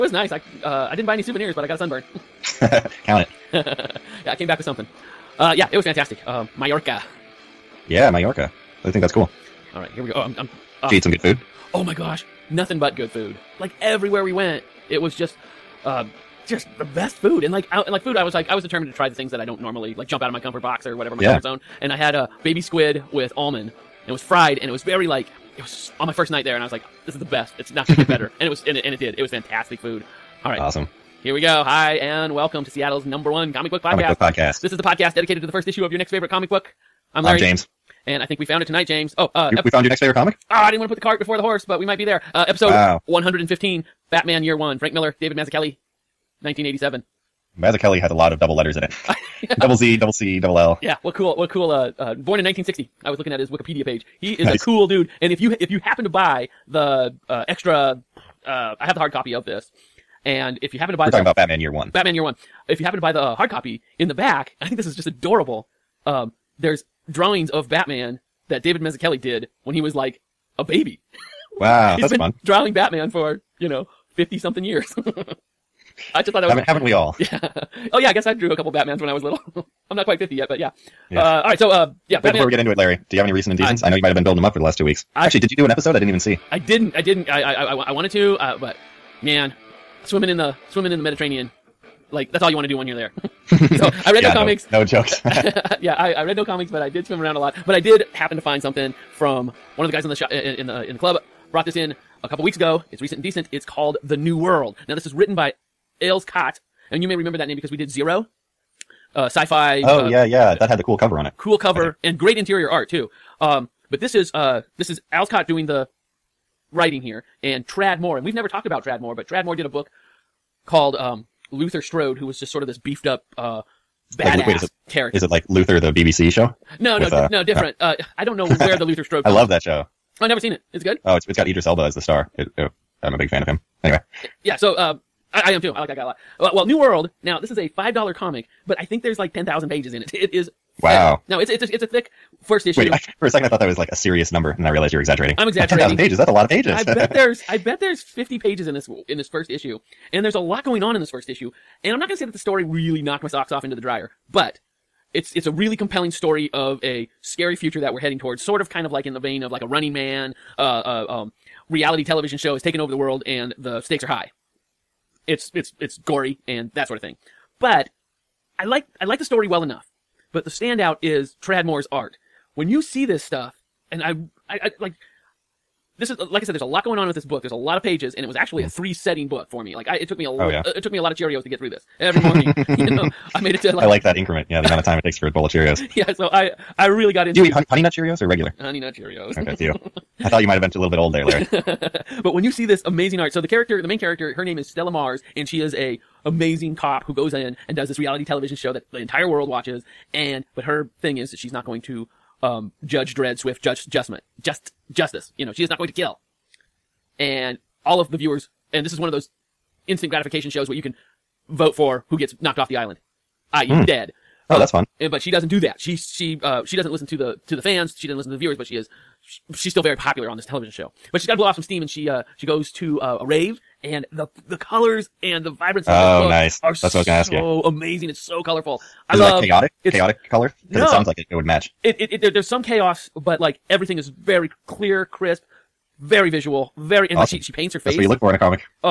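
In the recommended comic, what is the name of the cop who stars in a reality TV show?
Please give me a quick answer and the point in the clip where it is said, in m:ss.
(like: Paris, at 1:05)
Stella Mars, at 3:14.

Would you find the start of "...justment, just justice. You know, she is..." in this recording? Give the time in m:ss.
3:23.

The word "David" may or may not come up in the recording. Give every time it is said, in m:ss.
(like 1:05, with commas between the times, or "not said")
0:45, 1:08.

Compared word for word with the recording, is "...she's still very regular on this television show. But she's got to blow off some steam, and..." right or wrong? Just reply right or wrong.
wrong.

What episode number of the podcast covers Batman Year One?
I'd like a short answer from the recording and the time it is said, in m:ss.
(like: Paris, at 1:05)
115, at 0:43.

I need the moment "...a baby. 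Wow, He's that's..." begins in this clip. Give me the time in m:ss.
1:10.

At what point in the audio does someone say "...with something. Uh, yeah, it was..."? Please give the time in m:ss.
0:04.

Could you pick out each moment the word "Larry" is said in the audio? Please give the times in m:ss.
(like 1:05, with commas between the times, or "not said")
0:37, 1:22, 3:11.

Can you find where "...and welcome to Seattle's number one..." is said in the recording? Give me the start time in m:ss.
0:31.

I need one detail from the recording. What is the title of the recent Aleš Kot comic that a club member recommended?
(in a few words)
The New World.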